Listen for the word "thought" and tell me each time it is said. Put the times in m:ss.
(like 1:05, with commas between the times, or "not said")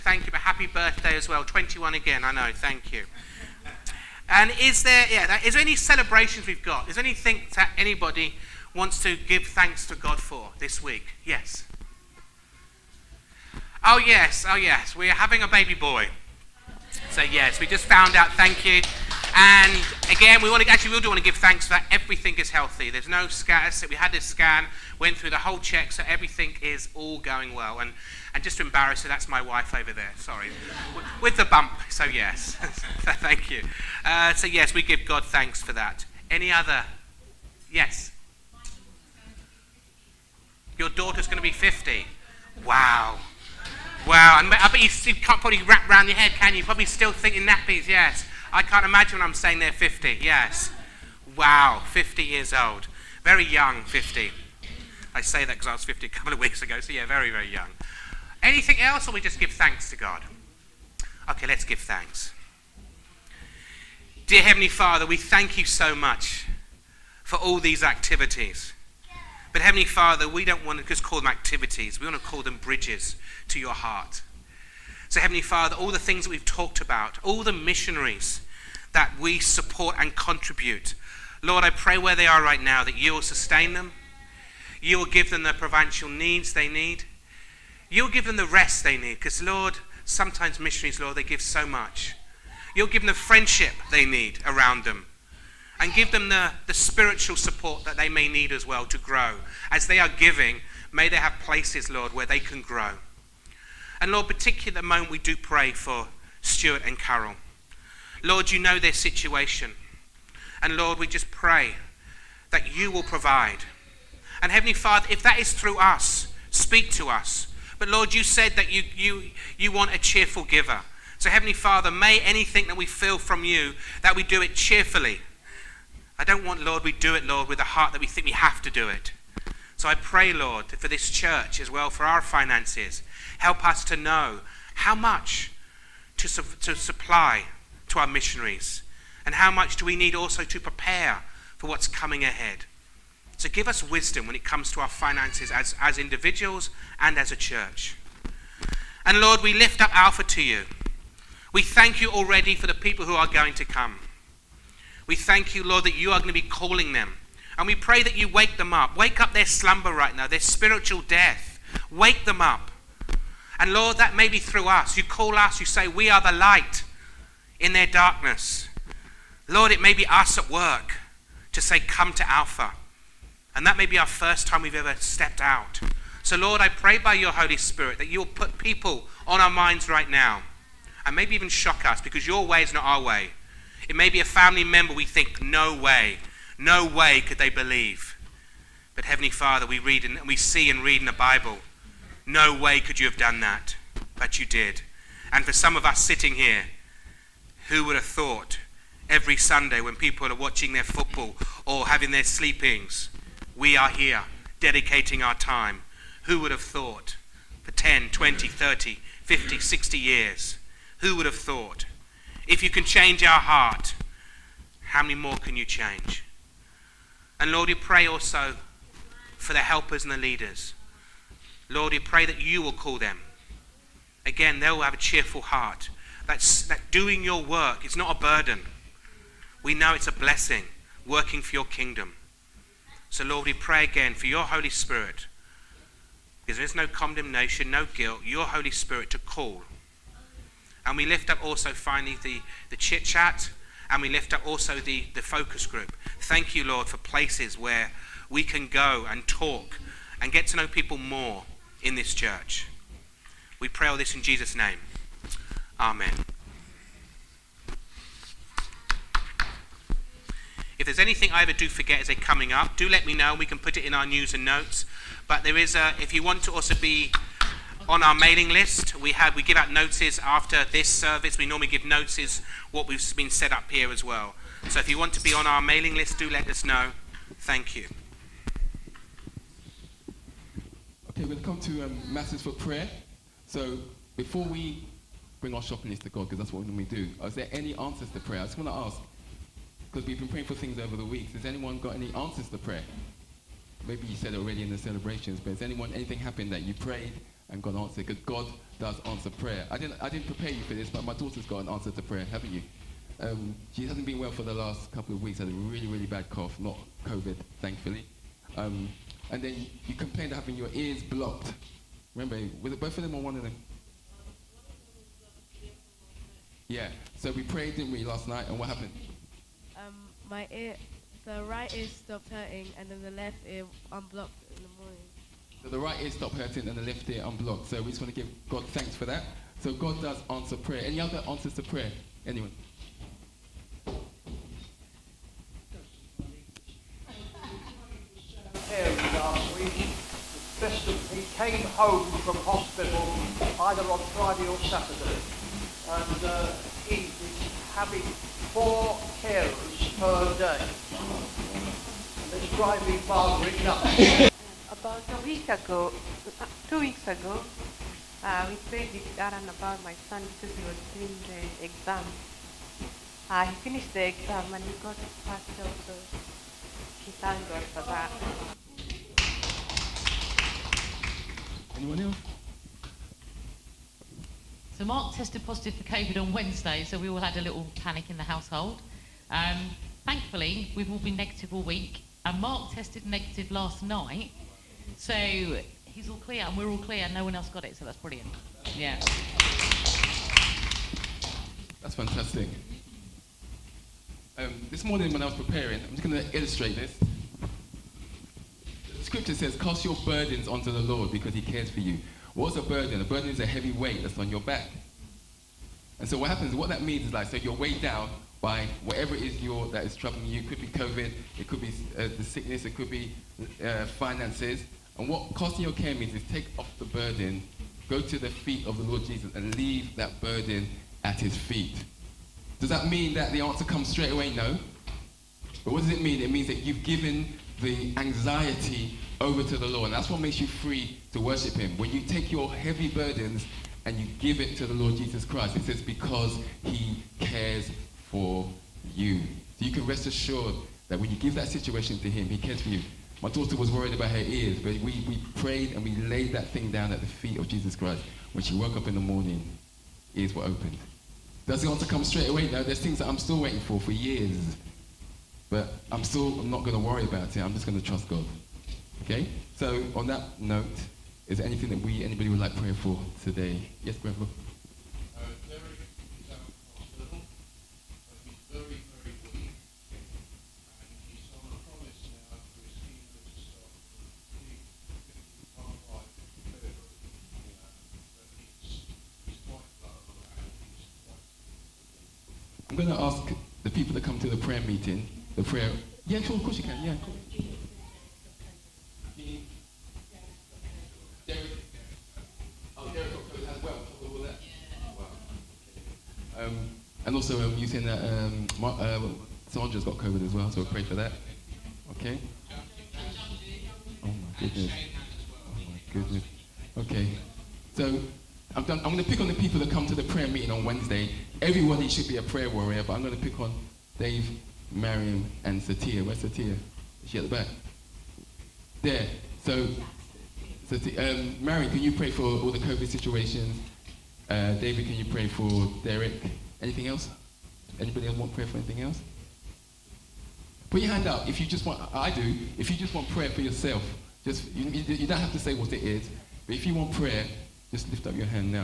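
3:18, 3:26, 3:31.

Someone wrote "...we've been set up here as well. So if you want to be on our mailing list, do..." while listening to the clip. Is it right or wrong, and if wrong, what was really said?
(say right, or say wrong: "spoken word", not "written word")
right.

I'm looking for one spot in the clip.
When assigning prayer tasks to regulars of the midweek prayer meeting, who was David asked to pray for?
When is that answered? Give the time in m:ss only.
8:45.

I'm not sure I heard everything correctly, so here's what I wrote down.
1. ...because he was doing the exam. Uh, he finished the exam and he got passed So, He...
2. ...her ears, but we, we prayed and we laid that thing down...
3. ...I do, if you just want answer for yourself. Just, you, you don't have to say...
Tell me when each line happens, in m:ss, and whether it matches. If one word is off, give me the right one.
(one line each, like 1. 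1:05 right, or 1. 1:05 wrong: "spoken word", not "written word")
1. 6:00 right
2. 7:24 right
3. 8:51 wrong: "prayer", not "answer".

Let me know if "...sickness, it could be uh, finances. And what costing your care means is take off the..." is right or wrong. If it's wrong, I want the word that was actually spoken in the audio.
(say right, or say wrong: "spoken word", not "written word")
right.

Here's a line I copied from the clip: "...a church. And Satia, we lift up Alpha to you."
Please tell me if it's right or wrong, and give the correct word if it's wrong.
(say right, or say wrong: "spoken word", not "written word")
wrong: "Lord", not "Satia".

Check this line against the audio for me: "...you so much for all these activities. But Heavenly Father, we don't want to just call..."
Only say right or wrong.
right.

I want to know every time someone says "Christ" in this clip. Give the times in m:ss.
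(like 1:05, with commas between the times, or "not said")
7:15, 7:27.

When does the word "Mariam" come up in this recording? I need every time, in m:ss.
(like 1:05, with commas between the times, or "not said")
8:34, 8:41.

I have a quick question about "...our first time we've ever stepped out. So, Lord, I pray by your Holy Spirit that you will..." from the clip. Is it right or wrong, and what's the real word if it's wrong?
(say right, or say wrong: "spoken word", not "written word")
right.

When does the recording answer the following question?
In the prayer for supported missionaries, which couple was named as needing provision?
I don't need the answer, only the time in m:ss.
1:46.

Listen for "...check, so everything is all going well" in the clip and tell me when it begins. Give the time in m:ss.
0:25.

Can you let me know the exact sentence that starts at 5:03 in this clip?
Um, she hasn't been well for the last couple of weeks.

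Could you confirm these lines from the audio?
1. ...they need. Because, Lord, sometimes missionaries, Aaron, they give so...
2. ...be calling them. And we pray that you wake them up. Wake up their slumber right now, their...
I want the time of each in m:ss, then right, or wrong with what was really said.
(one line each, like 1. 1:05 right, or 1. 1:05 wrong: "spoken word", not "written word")
1. 1:28 wrong: "Lord", not "Aaron"
2. 2:36 right.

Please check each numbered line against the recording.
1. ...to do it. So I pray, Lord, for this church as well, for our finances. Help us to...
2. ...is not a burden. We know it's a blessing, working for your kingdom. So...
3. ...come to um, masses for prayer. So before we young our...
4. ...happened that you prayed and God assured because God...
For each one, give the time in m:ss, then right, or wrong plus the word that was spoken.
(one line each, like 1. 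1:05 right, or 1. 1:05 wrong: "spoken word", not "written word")
1. 2:08 right
2. 3:47 right
3. 4:41 wrong: "bring", not "young"
4. 4:56 wrong: "answered", not "assured".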